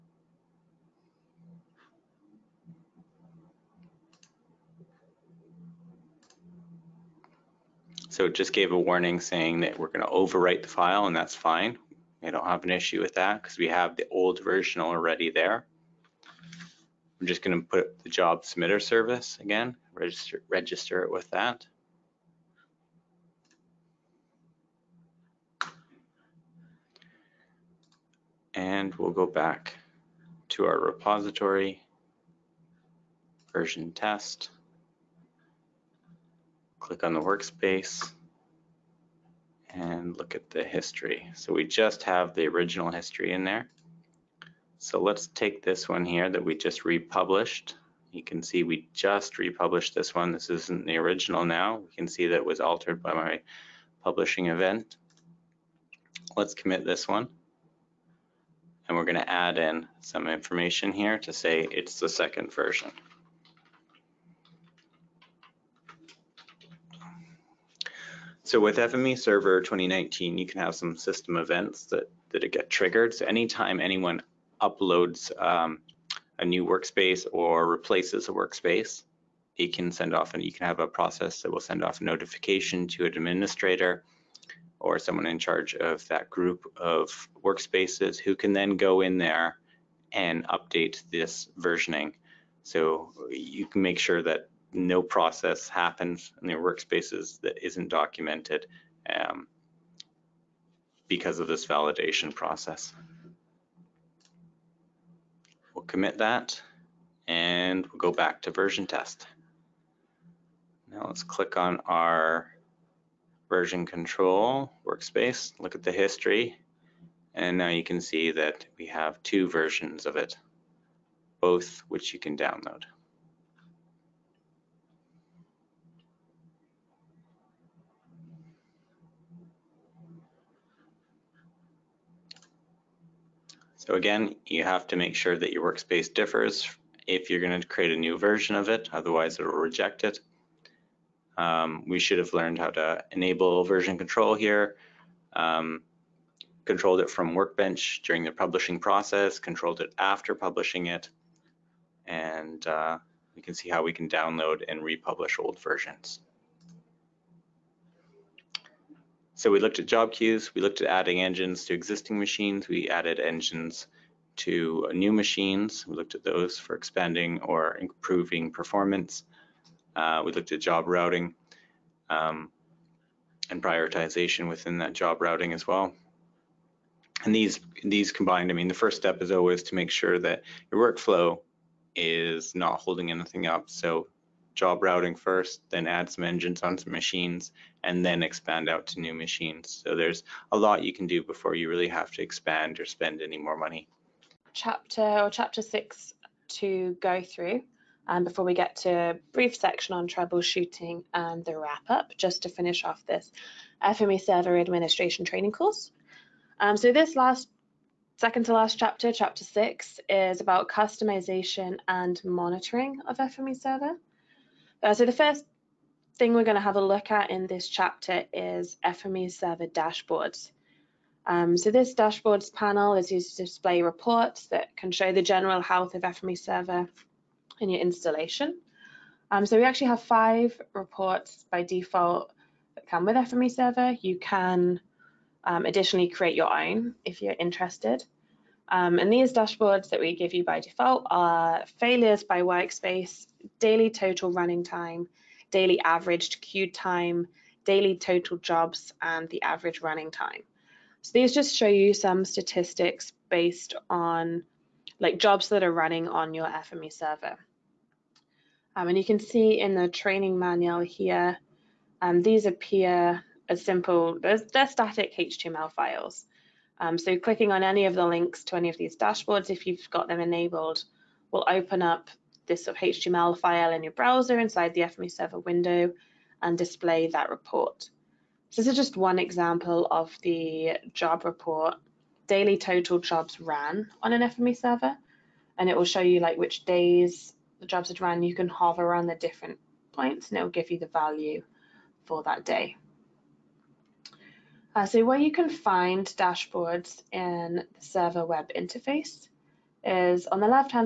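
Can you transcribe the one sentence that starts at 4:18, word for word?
Um, and you can see in the training manual here, um, these appear as simple, they're, they're static HTML files.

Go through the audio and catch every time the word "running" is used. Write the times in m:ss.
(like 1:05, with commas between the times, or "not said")
4:04, 4:09, 4:15.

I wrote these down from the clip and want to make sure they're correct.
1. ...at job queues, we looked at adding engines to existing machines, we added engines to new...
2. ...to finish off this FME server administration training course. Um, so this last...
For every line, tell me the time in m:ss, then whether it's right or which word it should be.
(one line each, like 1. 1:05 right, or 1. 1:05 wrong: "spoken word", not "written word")
1. 2:39 right
2. 3:22 right.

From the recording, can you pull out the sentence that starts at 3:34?
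Uh, so the first thing we're going to have a look at in this chapter is FME server dashboards.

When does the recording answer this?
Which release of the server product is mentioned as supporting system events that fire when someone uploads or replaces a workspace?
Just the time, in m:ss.
1:08.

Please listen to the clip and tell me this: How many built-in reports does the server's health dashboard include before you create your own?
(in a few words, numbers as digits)
5.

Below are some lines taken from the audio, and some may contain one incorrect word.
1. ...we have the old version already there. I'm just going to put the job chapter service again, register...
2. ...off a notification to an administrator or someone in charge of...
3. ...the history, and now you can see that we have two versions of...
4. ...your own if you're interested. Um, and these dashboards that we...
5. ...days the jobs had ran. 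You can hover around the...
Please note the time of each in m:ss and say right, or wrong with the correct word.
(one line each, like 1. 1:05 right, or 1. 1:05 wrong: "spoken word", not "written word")
1. 0:13 wrong: "submitter", not "chapter"
2. 1:21 right
3. 1:55 right
4. 3:56 right
5. 4:46 right.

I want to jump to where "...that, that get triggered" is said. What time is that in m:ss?
1:11.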